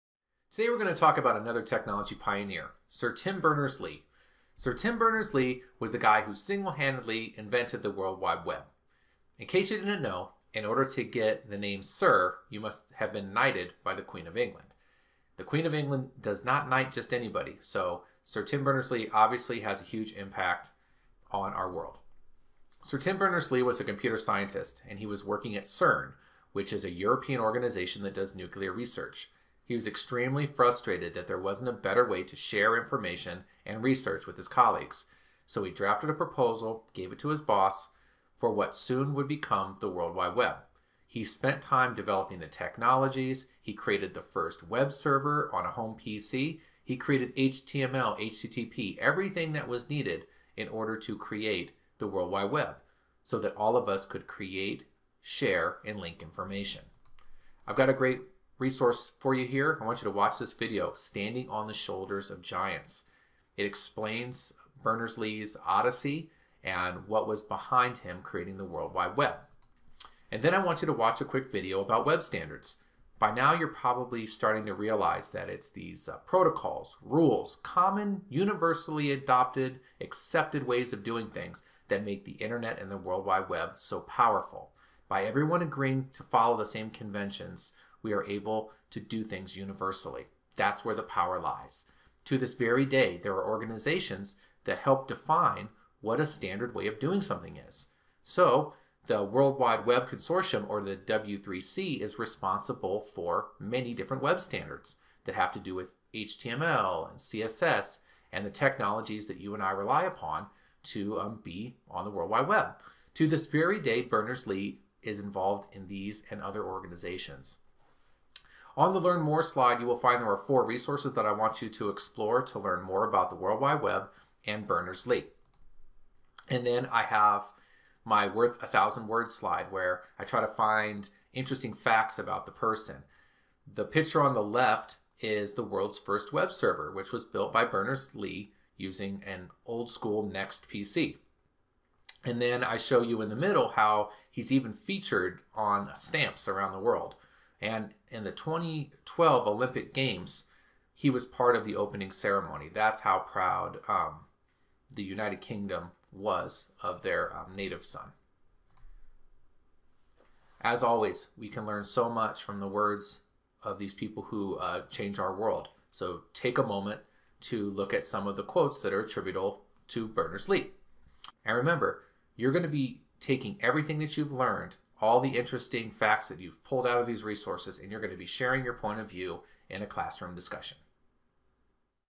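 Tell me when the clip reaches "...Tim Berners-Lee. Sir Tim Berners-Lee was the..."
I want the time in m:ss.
0:03.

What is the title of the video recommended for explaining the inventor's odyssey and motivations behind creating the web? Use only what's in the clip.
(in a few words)
Standing on the Shoulders of Giants.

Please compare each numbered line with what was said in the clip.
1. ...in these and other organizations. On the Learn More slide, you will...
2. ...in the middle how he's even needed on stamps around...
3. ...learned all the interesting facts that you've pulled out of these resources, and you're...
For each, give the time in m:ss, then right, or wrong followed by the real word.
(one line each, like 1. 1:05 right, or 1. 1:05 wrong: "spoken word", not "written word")
1. 1:55 right
2. 2:23 wrong: "featured", not "needed"
3. 2:54 right.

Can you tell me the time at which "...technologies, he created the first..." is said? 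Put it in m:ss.
0:42.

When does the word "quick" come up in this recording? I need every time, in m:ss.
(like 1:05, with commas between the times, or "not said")
1:11.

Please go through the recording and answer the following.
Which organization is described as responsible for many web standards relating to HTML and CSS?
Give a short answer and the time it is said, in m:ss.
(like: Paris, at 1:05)
World Wide Web Consortium, at 1:39.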